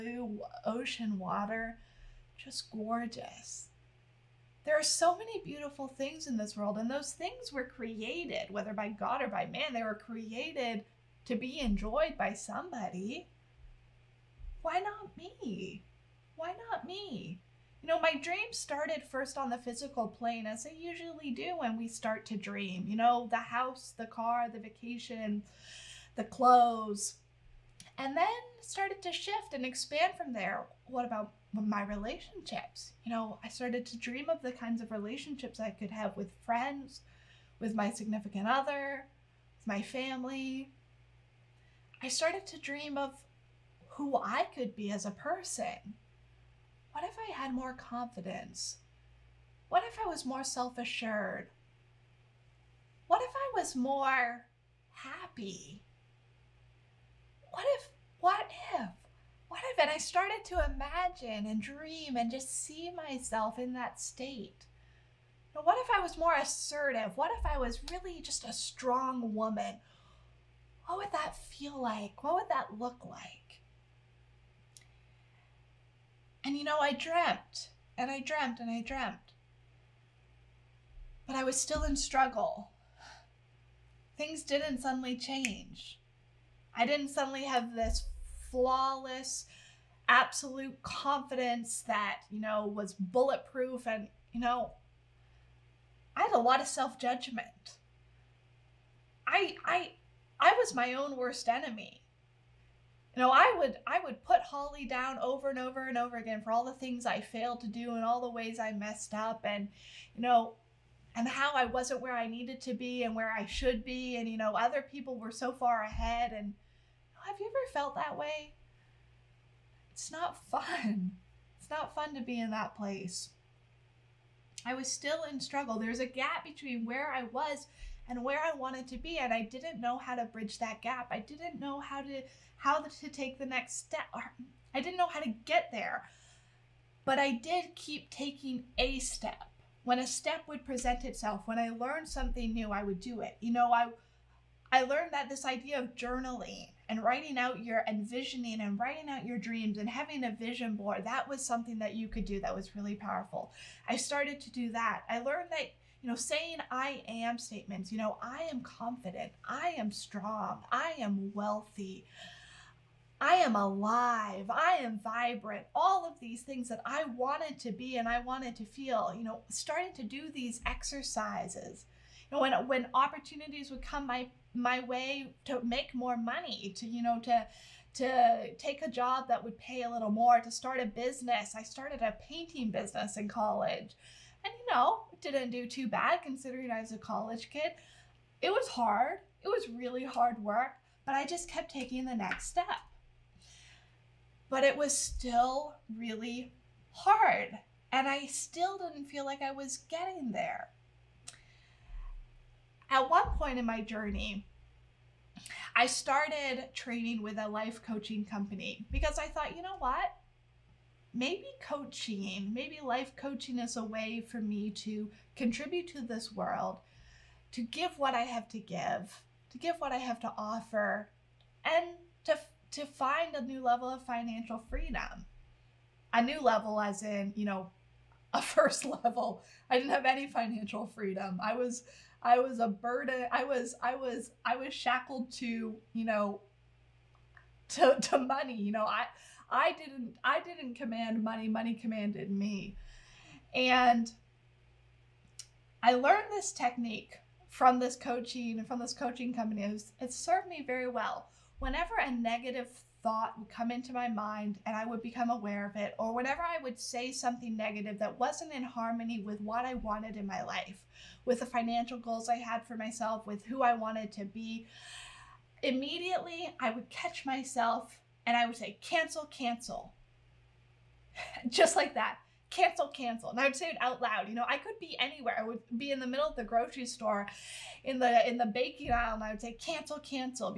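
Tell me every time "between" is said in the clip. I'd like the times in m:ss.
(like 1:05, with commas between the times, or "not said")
2:06.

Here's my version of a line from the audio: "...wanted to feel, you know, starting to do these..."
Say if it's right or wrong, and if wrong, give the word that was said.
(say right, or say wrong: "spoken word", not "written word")
right.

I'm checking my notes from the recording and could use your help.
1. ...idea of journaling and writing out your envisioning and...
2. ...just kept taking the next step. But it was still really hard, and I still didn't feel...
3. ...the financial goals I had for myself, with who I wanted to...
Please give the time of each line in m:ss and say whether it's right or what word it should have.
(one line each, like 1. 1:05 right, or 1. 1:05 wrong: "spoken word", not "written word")
1. 2:25 right
2. 3:11 right
3. 4:21 right.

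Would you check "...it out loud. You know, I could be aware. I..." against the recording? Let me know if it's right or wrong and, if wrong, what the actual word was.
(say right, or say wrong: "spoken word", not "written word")
wrong: "anywhere", not "aware".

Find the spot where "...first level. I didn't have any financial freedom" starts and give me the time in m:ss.
3:48.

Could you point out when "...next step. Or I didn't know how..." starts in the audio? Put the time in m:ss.
2:13.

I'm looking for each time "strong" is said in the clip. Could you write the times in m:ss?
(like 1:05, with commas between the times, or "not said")
1:08, 2:39.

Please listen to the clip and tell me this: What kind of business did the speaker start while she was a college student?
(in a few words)
painting business.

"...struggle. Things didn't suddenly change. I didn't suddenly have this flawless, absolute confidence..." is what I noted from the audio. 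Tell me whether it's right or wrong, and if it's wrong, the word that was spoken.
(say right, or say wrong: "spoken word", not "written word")
right.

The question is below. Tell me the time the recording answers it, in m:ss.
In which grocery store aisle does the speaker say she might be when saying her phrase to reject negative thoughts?
4:38.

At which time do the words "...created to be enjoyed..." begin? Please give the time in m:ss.
0:09.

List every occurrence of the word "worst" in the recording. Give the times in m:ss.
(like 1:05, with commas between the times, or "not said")
1:41.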